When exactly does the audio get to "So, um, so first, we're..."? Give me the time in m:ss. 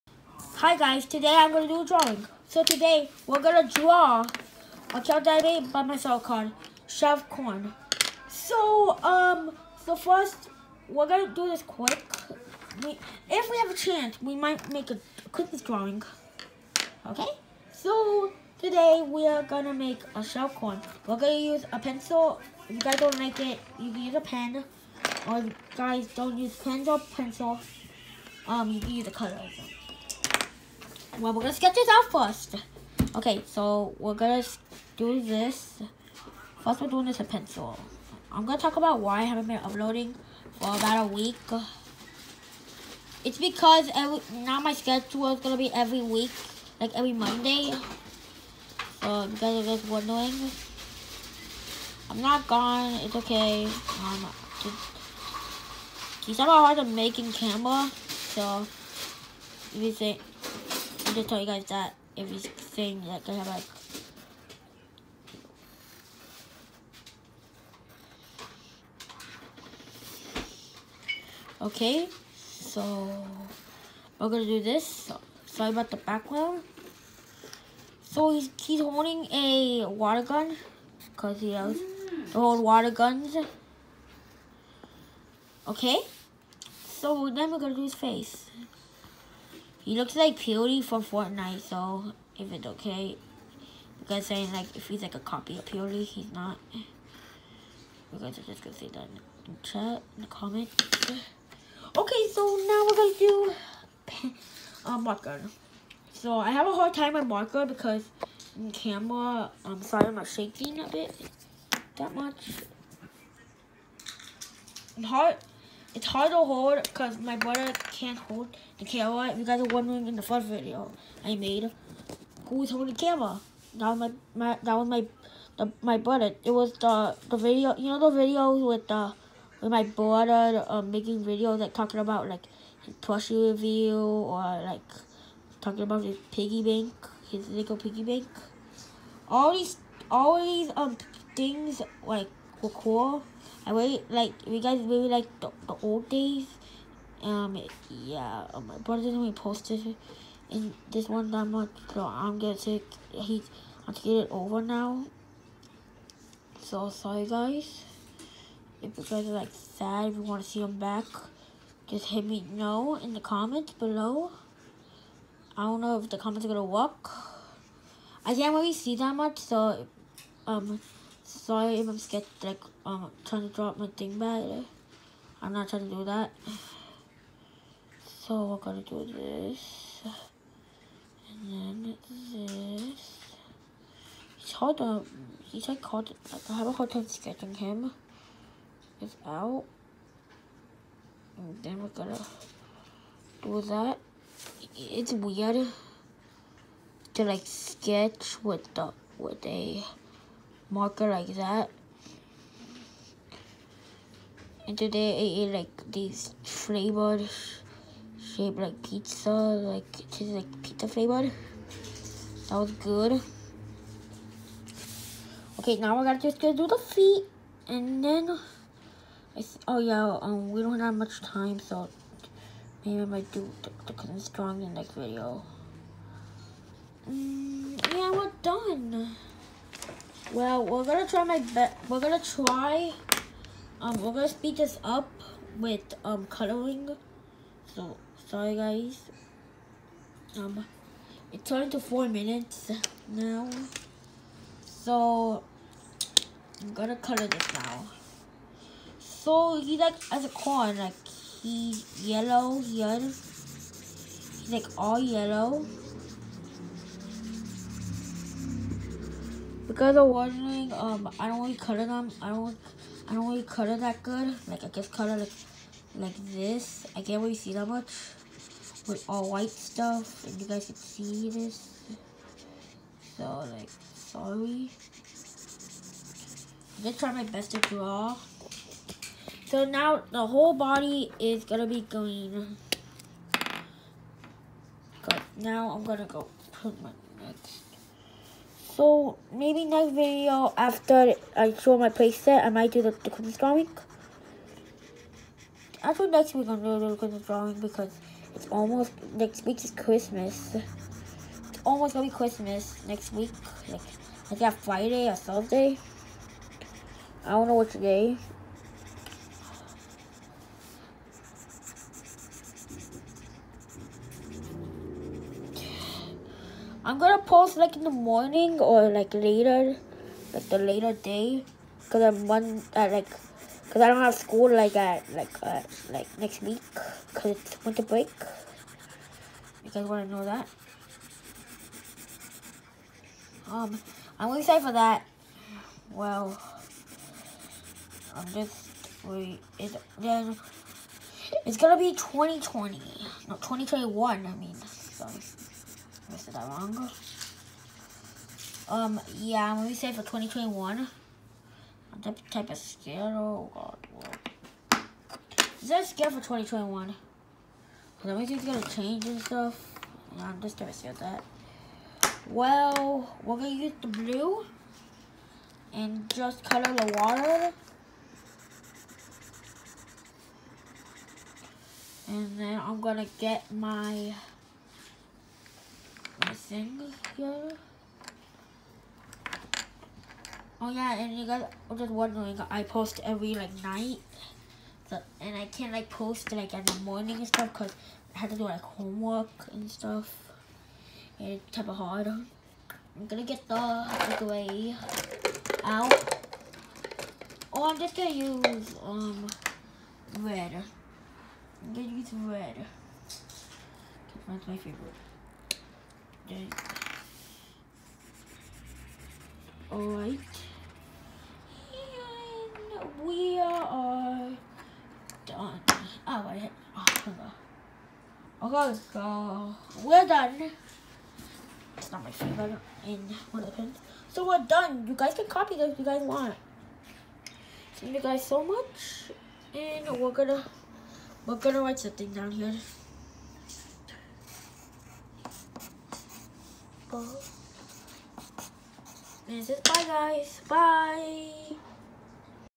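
0:08.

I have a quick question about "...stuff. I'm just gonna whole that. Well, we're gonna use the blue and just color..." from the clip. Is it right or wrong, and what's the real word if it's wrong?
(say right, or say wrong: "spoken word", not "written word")
wrong: "scale", not "whole".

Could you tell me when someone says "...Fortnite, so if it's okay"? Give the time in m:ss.
1:30.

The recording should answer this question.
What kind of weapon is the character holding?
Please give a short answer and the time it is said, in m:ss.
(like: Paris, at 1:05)
A water gun, at 1:19.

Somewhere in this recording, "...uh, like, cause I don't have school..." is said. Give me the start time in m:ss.
5:22.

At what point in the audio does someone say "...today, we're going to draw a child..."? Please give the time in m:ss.
0:02.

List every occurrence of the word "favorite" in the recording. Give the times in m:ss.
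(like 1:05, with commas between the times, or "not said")
6:44, 7:02.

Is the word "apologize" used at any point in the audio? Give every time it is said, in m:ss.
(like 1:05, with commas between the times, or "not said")
not said.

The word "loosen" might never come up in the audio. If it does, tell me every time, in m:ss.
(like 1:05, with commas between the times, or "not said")
not said.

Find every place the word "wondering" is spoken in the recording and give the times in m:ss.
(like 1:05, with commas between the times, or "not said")
0:49, 1:59, 6:21.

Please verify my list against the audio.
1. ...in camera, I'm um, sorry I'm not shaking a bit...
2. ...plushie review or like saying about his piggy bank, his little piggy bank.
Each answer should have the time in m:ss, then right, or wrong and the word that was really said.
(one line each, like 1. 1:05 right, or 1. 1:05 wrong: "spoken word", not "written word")
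1. 1:48 right
2. 2:12 wrong: "talking", not "saying".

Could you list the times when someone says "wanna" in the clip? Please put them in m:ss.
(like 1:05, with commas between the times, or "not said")
2:40, 5:29.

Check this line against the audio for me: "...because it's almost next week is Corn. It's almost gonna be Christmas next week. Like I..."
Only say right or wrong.
wrong.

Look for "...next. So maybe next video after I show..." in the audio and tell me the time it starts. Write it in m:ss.
4:47.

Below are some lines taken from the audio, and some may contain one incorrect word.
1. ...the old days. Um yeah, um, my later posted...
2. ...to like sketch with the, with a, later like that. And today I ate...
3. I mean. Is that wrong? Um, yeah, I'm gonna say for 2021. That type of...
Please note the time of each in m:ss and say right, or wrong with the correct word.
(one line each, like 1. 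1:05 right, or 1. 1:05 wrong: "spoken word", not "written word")
1. 2:25 wrong: "brother", not "later"
2. 3:17 wrong: "marker", not "later"
3. 5:44 right.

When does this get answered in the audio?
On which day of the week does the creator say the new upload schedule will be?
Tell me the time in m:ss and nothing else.
0:46.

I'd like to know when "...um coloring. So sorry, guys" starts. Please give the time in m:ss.
3:56.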